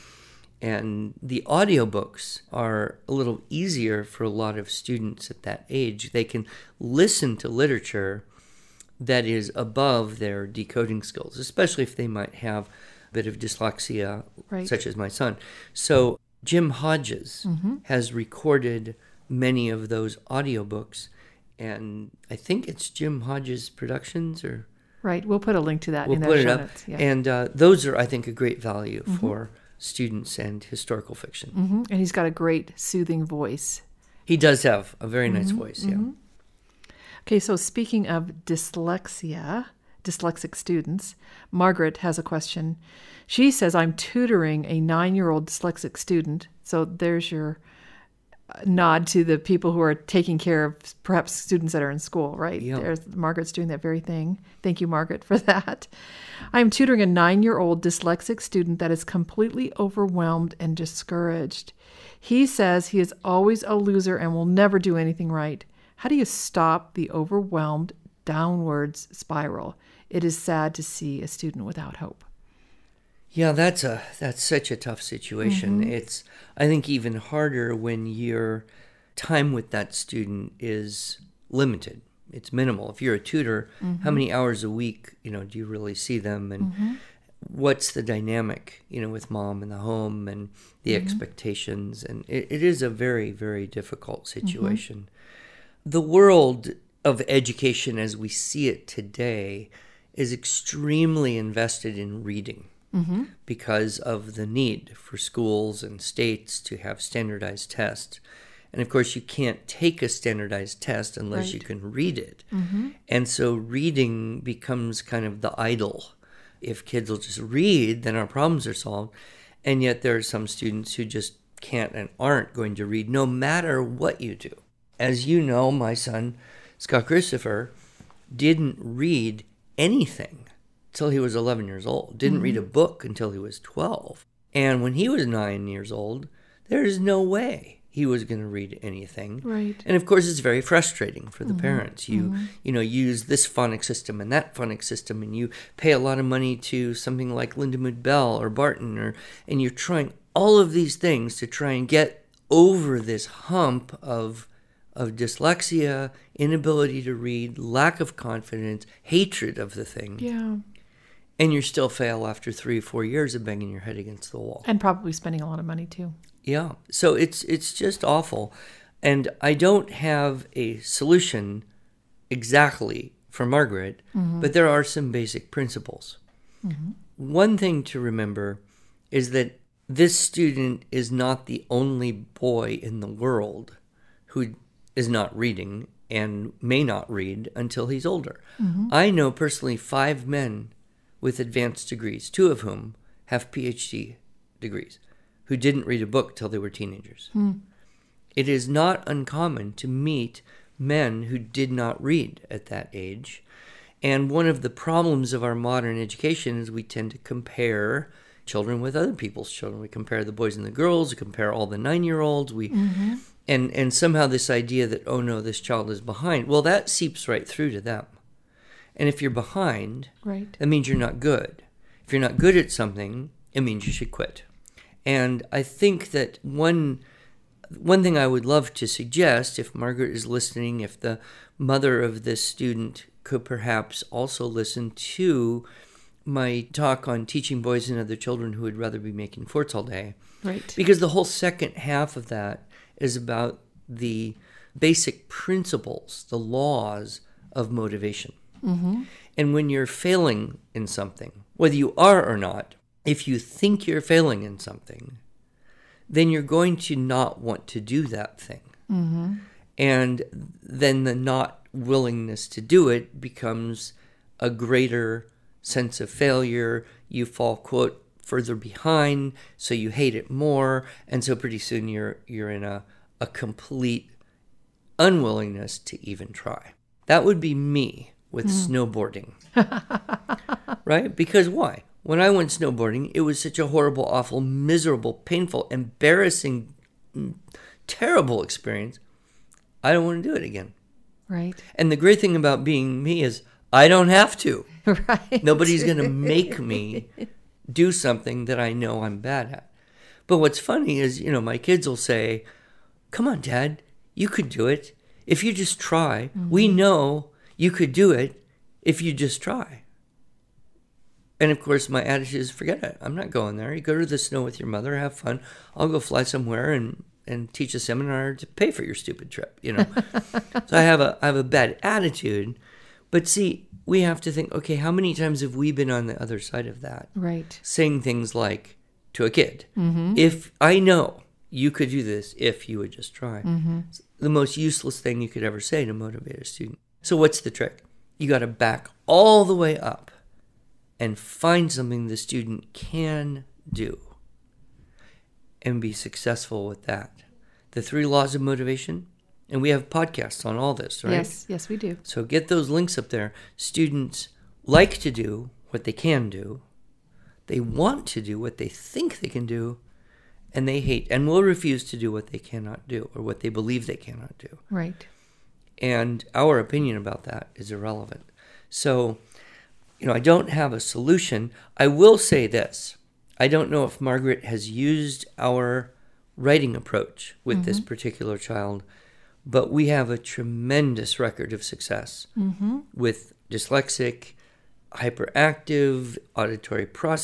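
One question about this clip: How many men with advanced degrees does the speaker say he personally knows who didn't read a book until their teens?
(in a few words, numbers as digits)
5.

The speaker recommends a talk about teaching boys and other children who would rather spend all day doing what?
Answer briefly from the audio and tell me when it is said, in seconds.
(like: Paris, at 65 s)
making forts, at 239 s.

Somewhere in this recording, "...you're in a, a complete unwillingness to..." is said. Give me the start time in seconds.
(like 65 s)
272 s.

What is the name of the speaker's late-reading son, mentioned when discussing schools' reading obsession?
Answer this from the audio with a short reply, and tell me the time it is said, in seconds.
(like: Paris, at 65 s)
Scott Christopher, at 126 s.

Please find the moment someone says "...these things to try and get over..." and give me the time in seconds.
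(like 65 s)
150 s.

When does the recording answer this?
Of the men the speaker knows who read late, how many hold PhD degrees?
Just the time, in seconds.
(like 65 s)
192 s.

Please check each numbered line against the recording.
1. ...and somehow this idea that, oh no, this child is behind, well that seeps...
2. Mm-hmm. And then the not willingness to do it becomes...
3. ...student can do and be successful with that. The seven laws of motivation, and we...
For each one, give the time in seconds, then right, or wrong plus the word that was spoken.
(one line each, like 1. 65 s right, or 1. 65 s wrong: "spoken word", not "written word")
1. 213 s right
2. 258 s right
3. 342 s wrong: "three", not "seven".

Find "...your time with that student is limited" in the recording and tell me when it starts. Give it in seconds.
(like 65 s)
78 s.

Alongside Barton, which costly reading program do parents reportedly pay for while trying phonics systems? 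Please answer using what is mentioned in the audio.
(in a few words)
Lindamood-Bell.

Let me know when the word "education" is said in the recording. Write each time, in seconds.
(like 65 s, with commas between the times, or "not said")
97 s, 205 s.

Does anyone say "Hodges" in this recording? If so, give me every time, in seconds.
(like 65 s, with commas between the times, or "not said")
16 s, 23 s.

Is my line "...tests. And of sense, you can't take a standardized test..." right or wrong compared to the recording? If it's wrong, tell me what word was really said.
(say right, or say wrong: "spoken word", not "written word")
wrong: "course", not "sense".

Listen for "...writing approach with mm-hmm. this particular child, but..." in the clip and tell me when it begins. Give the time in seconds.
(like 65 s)
376 s.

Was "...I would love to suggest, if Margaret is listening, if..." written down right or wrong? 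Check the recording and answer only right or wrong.
right.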